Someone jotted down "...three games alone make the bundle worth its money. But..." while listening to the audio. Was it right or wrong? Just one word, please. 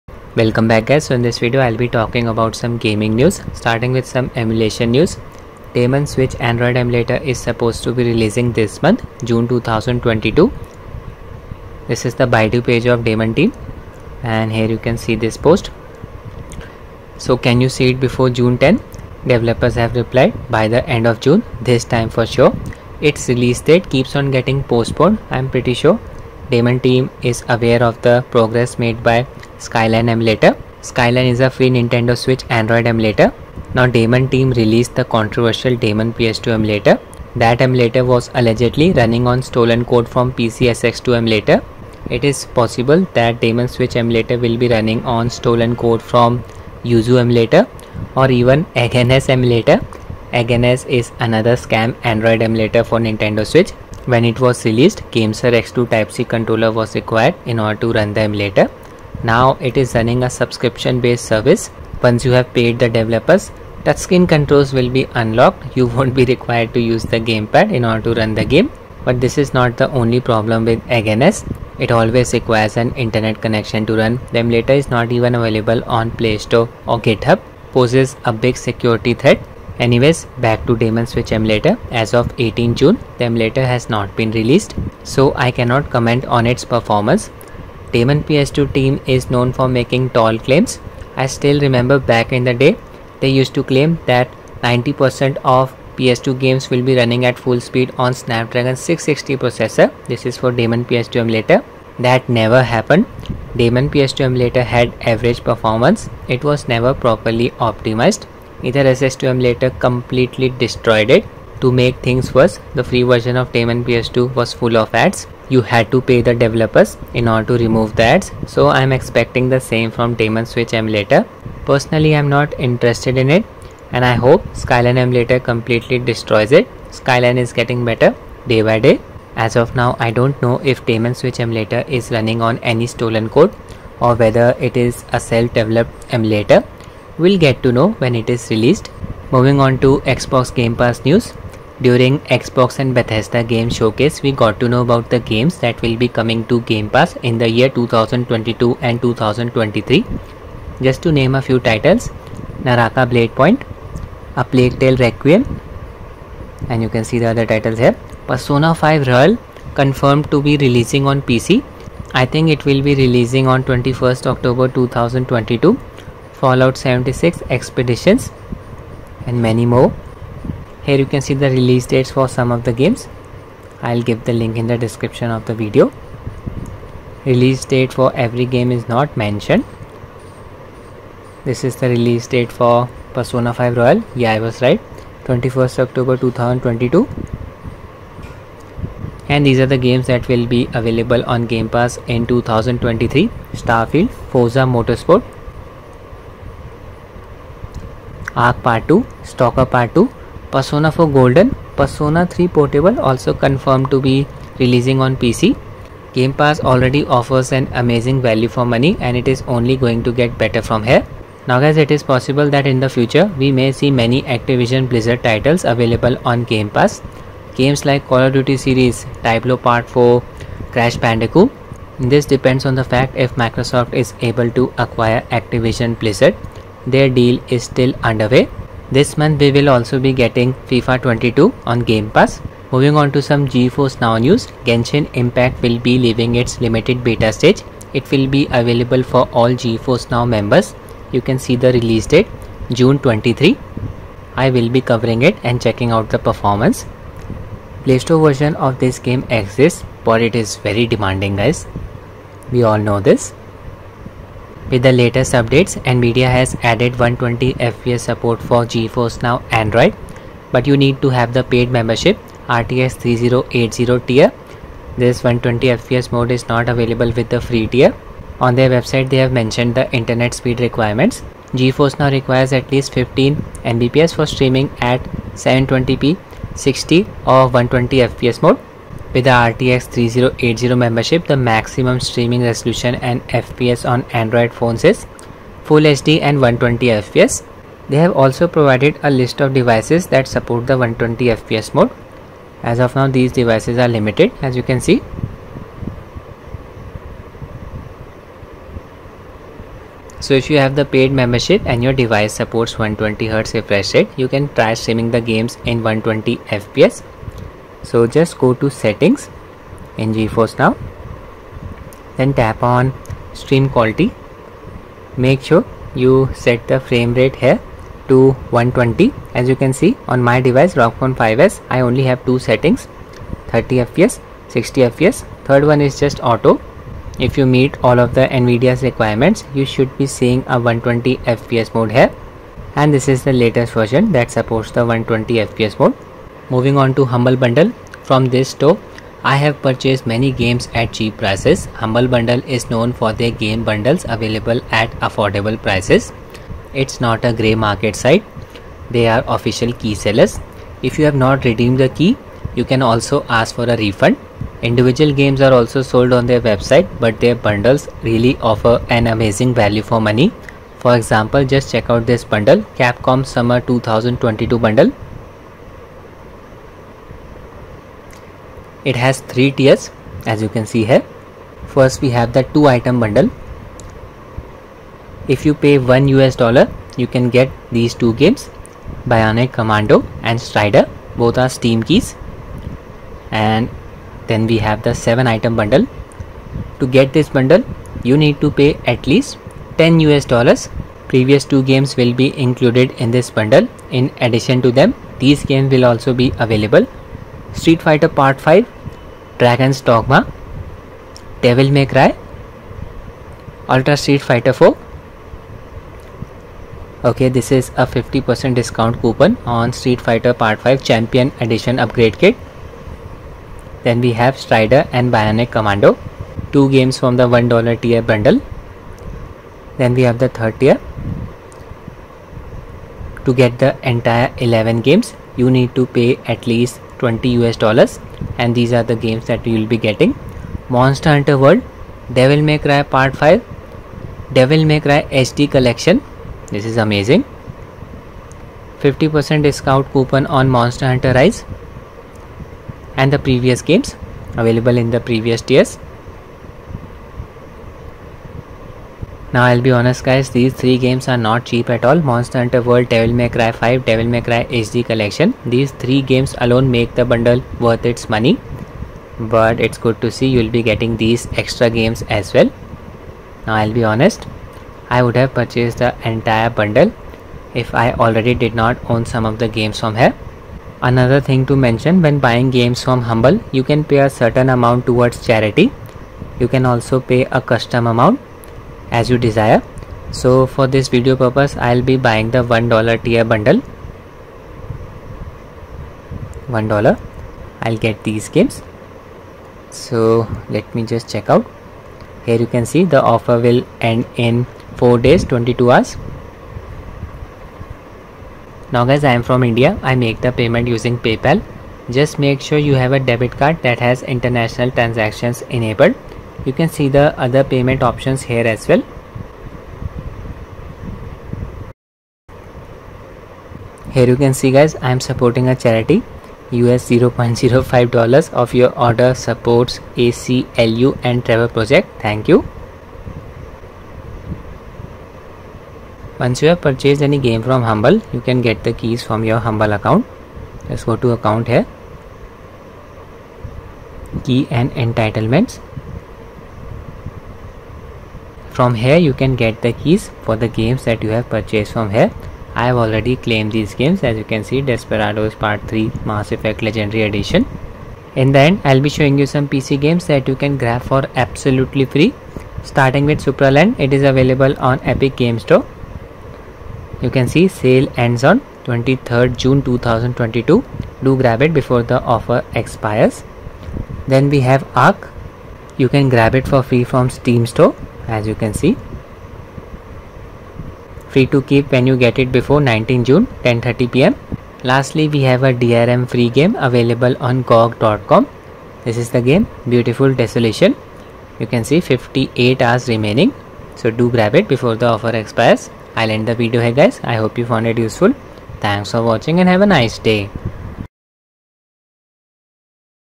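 right.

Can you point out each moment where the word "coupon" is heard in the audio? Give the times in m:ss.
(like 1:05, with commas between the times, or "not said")
6:49, 7:19.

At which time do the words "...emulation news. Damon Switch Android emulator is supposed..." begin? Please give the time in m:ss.
0:04.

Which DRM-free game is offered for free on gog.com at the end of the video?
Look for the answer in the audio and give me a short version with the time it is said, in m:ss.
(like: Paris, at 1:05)
Beautiful Desolation, at 9:39.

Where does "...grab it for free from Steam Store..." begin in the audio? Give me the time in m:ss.
9:26.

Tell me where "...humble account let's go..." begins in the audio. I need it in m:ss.
8:49.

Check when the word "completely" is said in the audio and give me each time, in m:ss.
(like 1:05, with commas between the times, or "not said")
1:49, 2:05.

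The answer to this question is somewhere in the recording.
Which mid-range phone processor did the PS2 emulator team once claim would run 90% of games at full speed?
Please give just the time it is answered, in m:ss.
1:38.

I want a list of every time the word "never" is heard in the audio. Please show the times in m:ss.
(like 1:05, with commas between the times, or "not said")
1:42, 1:46.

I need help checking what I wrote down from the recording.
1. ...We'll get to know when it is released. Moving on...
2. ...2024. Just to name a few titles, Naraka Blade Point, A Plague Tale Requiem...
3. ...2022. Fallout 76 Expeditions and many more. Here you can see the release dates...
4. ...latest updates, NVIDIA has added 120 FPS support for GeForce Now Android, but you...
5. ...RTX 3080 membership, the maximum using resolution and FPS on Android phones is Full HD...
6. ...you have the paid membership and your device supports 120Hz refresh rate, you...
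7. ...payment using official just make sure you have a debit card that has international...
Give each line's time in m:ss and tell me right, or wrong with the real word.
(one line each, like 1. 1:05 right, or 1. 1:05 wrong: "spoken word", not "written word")
1. 2:17 right
2. 2:29 wrong: "2023", not "2024"
3. 2:44 right
4. 4:14 right
5. 4:39 wrong: "streaming", not "using"
6. 5:00 right
7. 8:20 wrong: "paypal", not "official".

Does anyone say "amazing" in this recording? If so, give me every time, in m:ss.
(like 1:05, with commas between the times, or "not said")
3:27, 5:59, 7:16.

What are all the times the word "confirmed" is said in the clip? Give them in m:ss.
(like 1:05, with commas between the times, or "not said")
2:39, 3:23.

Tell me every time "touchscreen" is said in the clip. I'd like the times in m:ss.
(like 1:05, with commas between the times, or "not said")
1:03.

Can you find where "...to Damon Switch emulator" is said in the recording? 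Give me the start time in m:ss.
1:20.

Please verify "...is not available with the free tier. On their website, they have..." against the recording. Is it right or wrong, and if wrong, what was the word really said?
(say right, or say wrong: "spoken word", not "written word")
right.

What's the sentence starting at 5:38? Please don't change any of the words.
From this store, I have purchased many games at cheap prices.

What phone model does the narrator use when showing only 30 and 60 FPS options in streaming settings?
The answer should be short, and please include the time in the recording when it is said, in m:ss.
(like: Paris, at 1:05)
ROG Phone 5s, at 5:20.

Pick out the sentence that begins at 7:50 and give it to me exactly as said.
Another thing to mention when buying games from Humble, you can pay a certain amount towards charity.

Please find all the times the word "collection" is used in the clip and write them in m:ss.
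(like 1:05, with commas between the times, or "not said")
7:15, 7:34.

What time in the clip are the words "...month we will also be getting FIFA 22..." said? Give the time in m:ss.
3:49.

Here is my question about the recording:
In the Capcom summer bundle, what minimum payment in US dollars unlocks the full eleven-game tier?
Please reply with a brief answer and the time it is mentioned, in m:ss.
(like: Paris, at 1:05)
20 dollars, at 7:07.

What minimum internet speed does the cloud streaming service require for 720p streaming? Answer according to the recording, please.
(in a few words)
15 Mbps.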